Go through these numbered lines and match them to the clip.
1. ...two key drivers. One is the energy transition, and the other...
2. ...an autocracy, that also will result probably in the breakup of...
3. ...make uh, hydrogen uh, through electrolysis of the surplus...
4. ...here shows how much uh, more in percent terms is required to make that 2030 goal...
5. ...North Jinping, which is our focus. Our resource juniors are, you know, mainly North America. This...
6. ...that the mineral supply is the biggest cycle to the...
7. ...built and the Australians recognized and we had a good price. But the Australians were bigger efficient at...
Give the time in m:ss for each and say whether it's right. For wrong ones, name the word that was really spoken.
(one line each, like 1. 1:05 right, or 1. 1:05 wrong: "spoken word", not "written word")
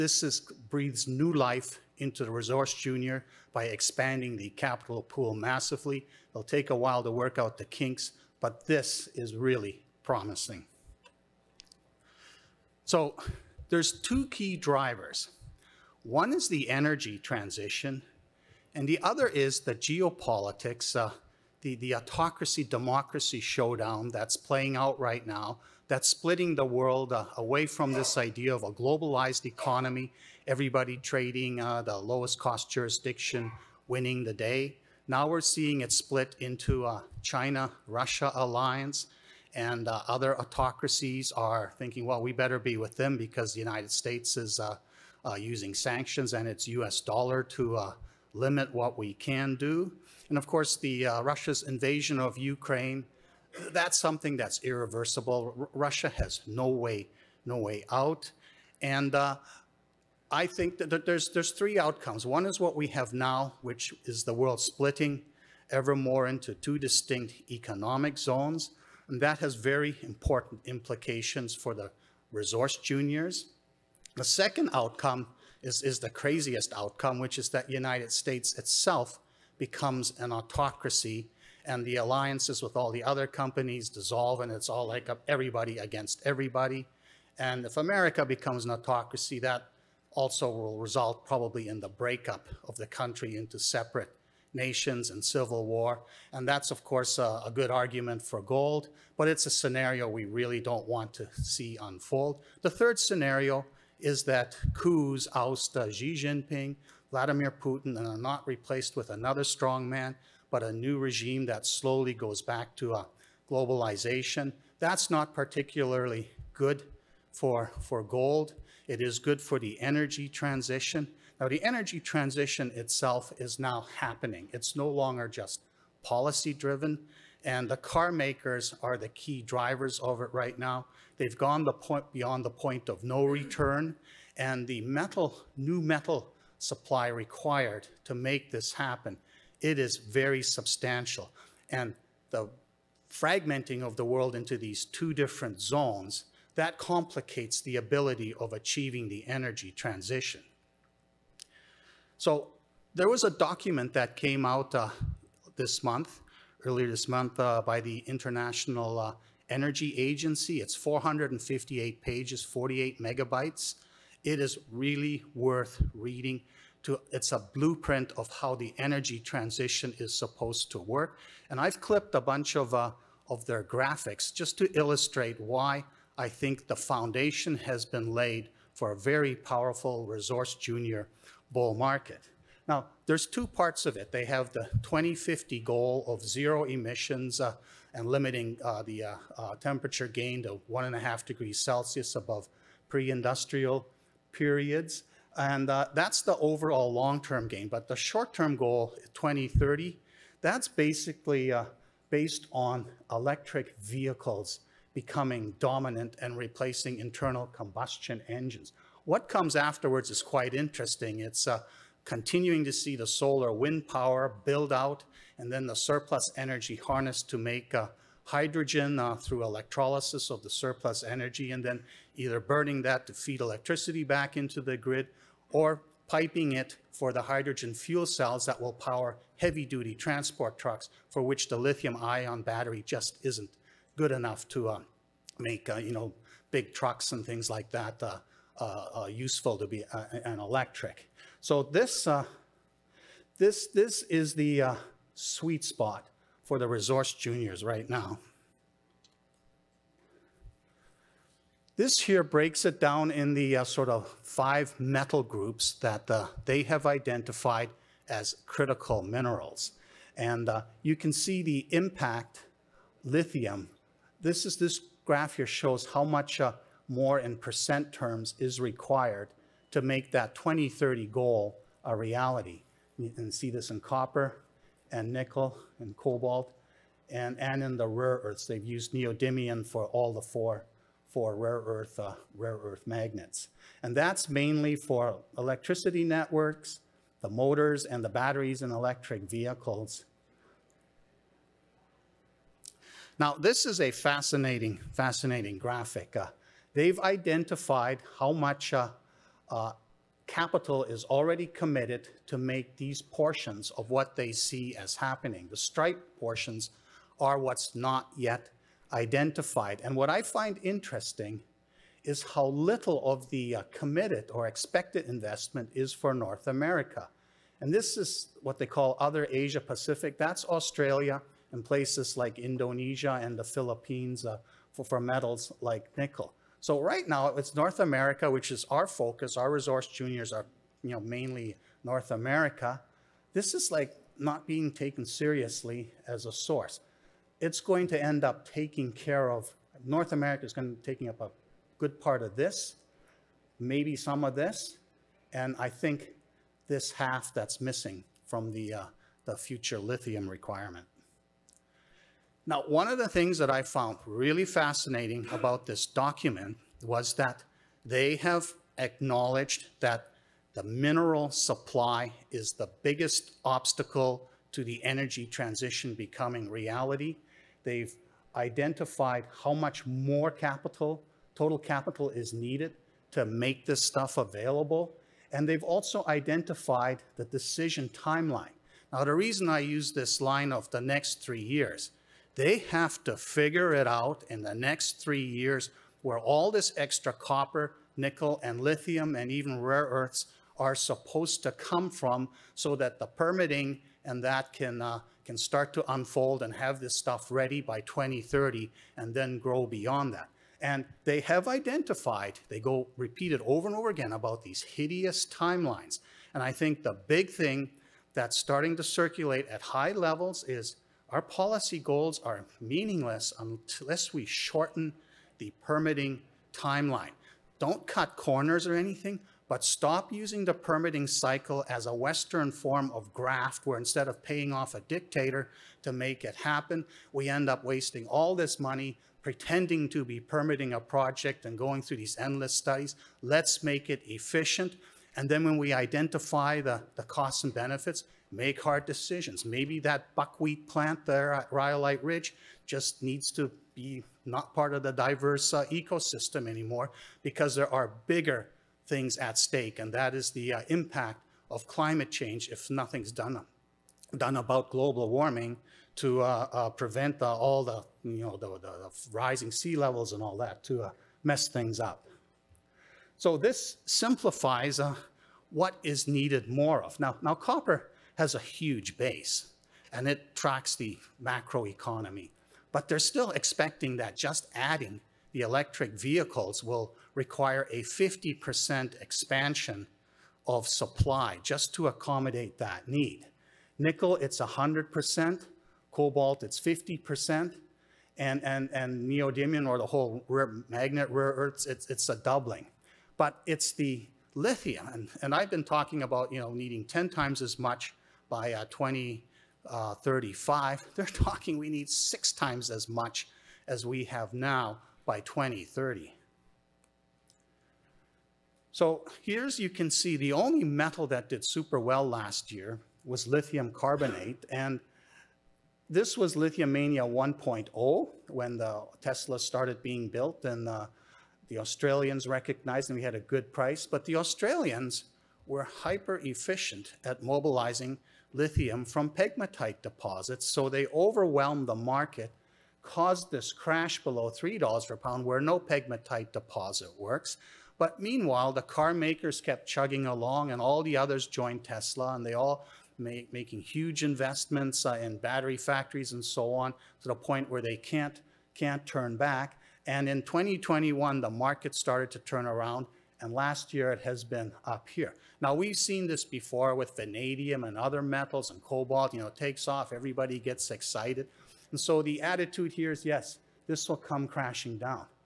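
1. 0:13 right
2. 1:28 right
3. 3:37 right
4. 4:25 right
5. 5:27 wrong: "America", not "Jinping"
6. 5:59 wrong: "obstacle", not "cycle"
7. 8:40 wrong: "hyper", not "bigger".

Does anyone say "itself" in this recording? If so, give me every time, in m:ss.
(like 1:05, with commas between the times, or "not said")
1:18, 2:02.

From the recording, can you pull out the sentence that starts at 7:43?
So this simplifies what is needed more of.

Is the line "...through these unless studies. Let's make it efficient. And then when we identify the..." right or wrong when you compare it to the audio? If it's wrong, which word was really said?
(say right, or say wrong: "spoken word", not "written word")
wrong: "endless", not "unless".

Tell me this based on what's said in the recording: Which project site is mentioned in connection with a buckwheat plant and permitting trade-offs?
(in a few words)
Rhyolite Ridge.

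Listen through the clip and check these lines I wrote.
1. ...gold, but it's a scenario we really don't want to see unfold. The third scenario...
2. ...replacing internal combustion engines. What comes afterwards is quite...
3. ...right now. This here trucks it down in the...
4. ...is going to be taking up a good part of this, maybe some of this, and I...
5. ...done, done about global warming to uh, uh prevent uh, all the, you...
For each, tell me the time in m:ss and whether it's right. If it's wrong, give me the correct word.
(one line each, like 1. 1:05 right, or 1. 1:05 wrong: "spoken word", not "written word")
1. 1:38 right
2. 3:26 right
3. 4:07 wrong: "breaks", not "trucks"
4. 5:40 right
5. 7:33 right.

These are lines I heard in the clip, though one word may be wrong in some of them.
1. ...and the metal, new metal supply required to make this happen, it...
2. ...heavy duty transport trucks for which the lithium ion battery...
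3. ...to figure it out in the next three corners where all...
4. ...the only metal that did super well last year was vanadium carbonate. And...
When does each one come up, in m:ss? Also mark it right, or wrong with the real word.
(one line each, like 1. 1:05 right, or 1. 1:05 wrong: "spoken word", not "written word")
1. 2:14 right
2. 3:49 right
3. 6:23 wrong: "years", not "corners"
4. 8:30 wrong: "lithium", not "vanadium".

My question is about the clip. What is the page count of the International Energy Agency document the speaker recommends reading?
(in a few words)
458.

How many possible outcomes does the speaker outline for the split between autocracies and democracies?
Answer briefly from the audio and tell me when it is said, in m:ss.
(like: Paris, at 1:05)
3, at 1:01.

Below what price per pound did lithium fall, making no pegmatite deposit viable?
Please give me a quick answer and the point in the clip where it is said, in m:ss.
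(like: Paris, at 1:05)
$3, at 8:54.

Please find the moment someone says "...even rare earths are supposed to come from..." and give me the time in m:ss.
6:29.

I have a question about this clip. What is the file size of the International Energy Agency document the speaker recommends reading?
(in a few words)
48 megabytes.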